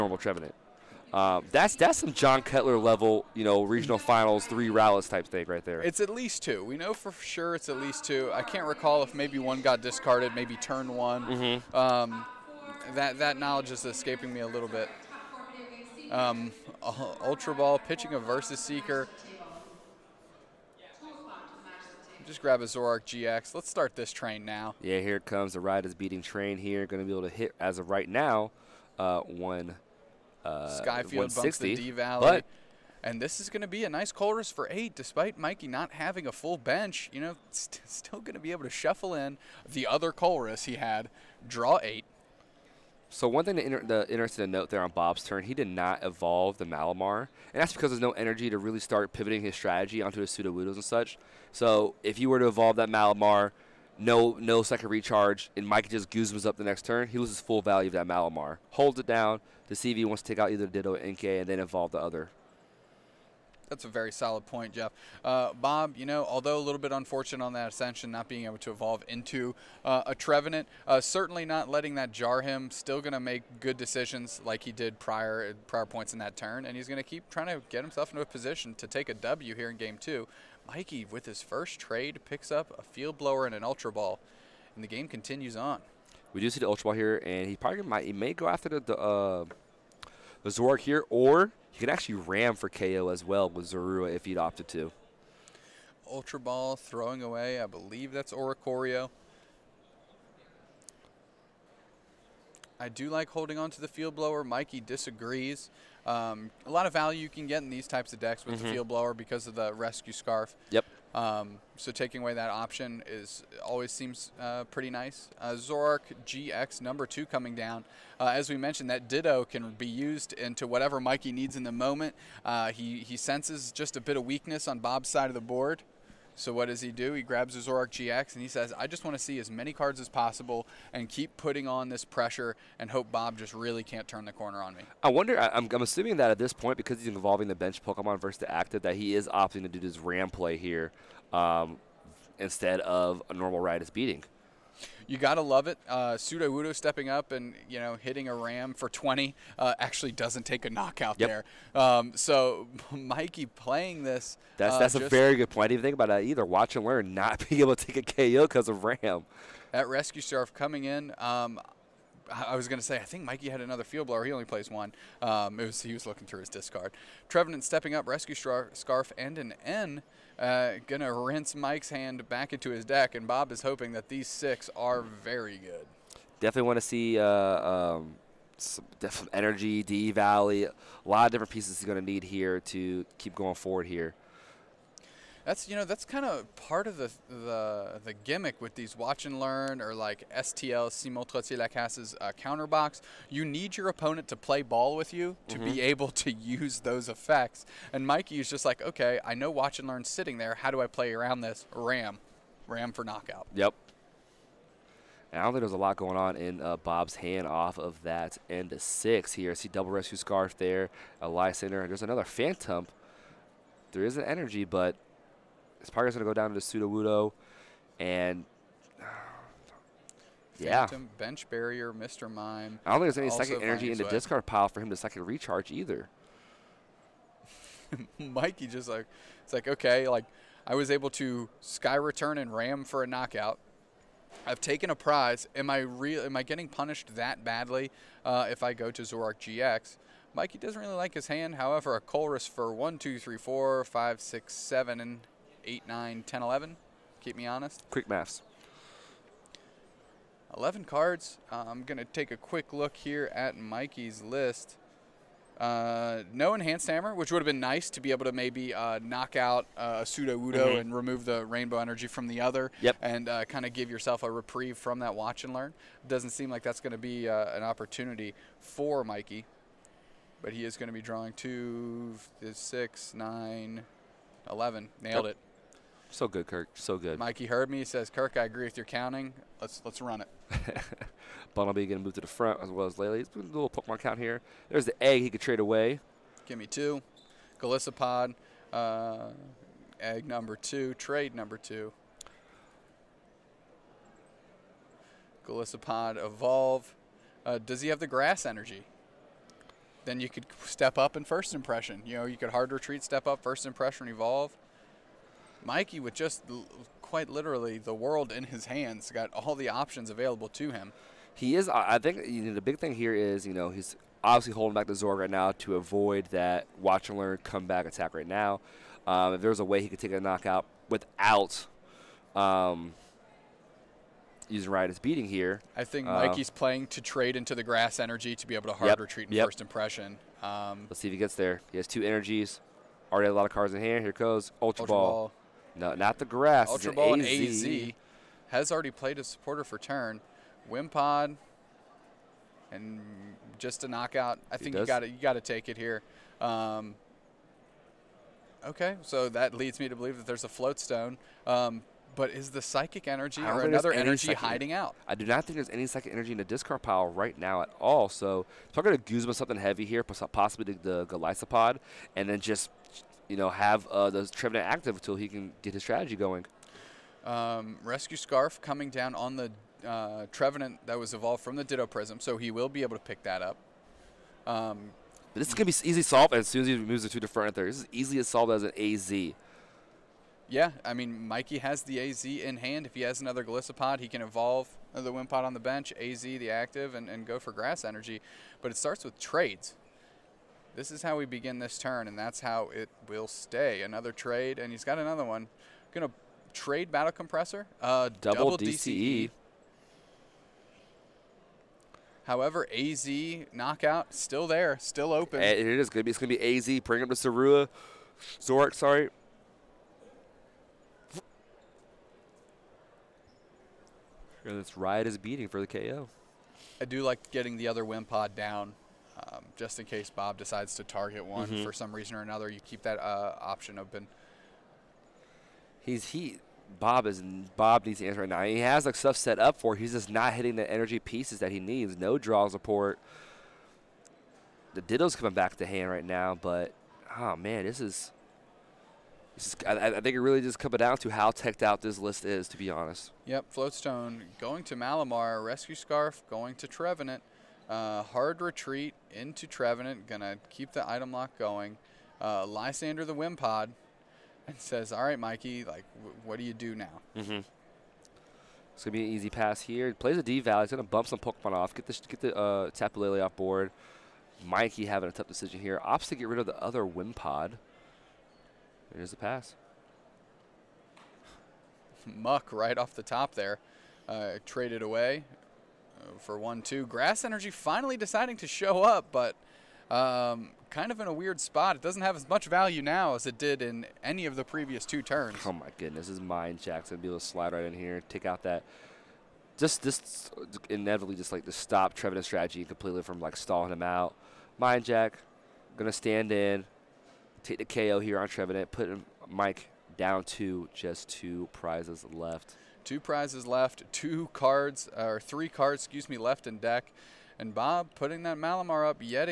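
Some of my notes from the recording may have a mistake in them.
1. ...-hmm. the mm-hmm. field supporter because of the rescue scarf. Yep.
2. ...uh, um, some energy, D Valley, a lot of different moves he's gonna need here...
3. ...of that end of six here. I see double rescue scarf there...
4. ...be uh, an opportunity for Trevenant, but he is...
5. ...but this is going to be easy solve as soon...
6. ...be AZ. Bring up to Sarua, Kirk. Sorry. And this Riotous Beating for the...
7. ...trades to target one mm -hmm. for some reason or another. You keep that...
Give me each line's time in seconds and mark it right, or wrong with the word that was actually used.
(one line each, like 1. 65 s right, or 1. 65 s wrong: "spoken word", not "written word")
1. 108 s wrong: "blower", not "supporter"
2. 177 s wrong: "pieces", not "moves"
3. 207 s right
4. 267 s wrong: "Mikey", not "Trevenant"
5. 375 s right
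6. 406 s wrong: "Zork", not "Kirk"
7. 420 s wrong: "decides", not "trades".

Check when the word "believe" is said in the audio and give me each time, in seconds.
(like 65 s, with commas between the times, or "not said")
97 s, 349 s.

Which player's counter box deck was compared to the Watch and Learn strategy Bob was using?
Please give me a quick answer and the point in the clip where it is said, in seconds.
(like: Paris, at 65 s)
Simon Lacasse, at 190 s.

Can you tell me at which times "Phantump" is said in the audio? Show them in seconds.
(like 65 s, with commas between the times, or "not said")
212 s, 220 s.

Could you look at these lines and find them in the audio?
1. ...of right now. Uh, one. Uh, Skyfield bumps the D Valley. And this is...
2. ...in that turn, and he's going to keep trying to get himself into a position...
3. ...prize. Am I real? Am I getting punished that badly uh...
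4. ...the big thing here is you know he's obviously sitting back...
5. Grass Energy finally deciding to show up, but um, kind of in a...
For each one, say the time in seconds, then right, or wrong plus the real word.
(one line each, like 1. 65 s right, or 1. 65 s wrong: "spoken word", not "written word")
1. 27 s right
2. 76 s right
3. 234 s right
4. 312 s wrong: "holding", not "sitting"
5. 476 s right.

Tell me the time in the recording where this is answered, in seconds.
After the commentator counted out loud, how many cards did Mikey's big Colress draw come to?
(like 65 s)
250 s.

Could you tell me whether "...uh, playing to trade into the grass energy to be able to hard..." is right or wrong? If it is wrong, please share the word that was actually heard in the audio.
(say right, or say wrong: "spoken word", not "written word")
right.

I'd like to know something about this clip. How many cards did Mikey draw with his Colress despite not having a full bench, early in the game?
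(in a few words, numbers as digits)
8.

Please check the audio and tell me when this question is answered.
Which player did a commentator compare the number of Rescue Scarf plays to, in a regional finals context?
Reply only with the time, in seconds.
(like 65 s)
2 s.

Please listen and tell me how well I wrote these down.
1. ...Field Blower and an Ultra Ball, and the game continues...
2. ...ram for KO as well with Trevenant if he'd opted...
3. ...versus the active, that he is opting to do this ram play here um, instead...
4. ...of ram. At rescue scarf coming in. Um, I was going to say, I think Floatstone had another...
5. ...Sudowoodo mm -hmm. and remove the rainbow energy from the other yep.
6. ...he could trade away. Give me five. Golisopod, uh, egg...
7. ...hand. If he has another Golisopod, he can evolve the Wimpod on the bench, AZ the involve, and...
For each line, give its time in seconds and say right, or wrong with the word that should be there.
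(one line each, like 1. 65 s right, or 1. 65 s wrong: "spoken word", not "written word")
1. 82 s right
2. 92 s wrong: "Zorua", not "Trevenant"
3. 138 s right
4. 158 s wrong: "Mikey", not "Floatstone"
5. 260 s right
6. 285 s wrong: "two", not "five"
7. 382 s wrong: "active", not "involve".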